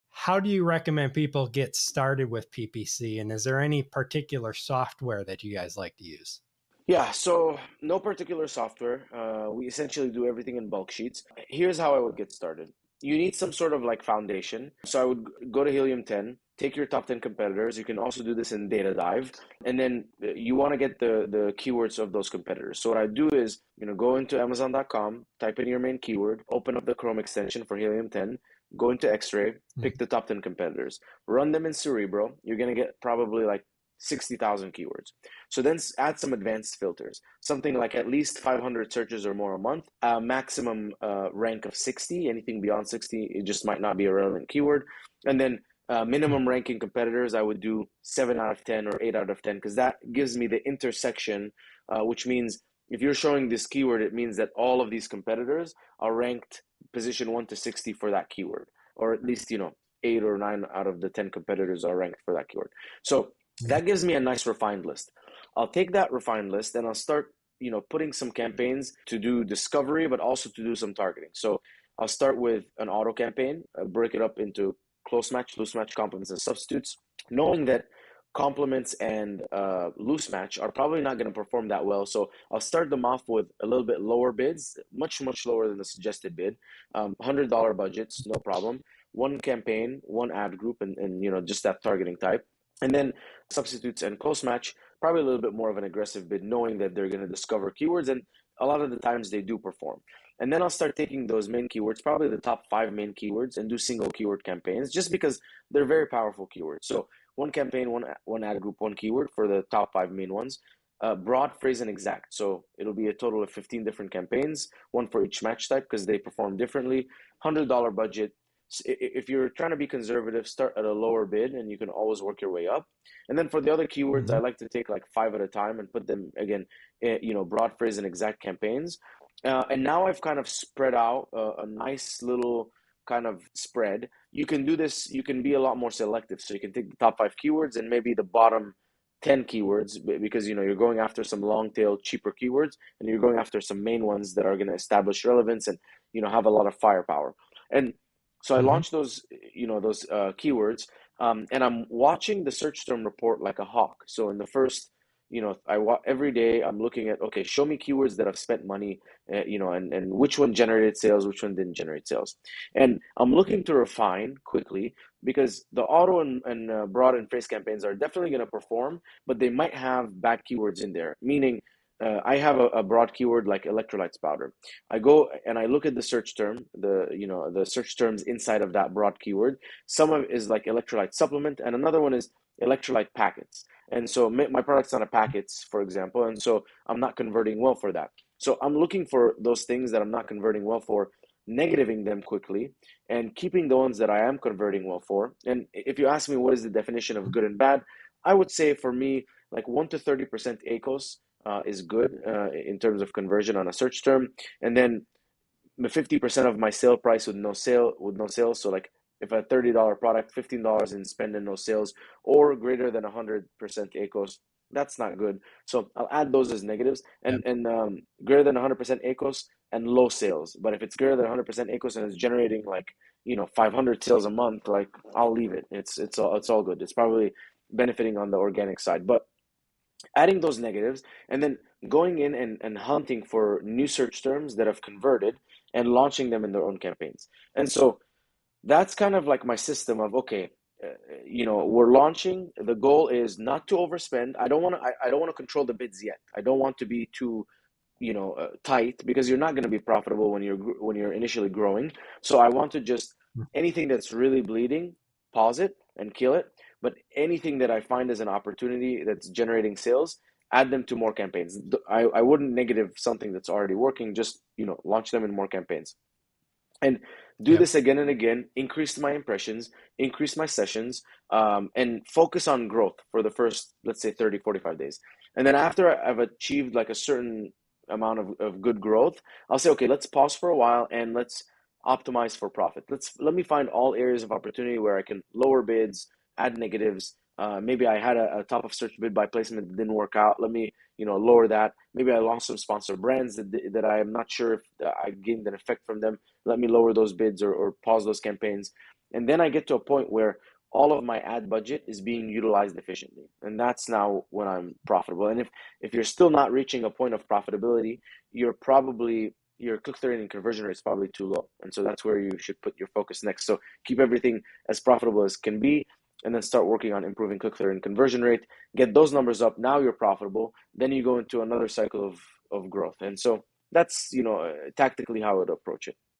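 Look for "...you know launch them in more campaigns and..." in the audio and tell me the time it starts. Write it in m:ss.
4:24.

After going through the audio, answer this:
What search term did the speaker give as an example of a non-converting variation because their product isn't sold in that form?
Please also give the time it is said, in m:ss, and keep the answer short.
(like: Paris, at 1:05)
electrolyte packets, at 3:02.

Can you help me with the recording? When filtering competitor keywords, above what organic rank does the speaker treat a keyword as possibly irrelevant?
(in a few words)
60.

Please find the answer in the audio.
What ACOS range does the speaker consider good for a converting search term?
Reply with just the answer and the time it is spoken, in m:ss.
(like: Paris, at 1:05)
1 to 30%, at 3:19.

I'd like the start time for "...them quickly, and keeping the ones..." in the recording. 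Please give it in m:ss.
3:12.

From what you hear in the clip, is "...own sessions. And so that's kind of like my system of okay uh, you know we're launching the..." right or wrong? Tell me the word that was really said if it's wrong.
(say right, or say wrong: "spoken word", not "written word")
wrong: "campaigns", not "sessions".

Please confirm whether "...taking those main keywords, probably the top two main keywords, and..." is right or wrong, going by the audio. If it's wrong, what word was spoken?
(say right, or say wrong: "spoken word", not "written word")
wrong: "five", not "two".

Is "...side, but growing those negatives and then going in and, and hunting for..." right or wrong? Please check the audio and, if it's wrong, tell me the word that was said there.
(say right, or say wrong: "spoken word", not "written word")
wrong: "adding", not "growing".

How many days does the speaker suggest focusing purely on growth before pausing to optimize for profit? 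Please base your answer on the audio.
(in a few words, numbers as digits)
30 to 45 days.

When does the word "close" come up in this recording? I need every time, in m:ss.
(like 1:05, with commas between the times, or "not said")
1:15, 1:34.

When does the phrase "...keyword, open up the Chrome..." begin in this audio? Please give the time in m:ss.
0:25.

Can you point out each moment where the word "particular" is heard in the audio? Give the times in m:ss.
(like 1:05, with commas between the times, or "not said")
0:03, 0:07.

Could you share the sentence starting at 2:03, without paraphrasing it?
And then for the other keywords, mm-hmm.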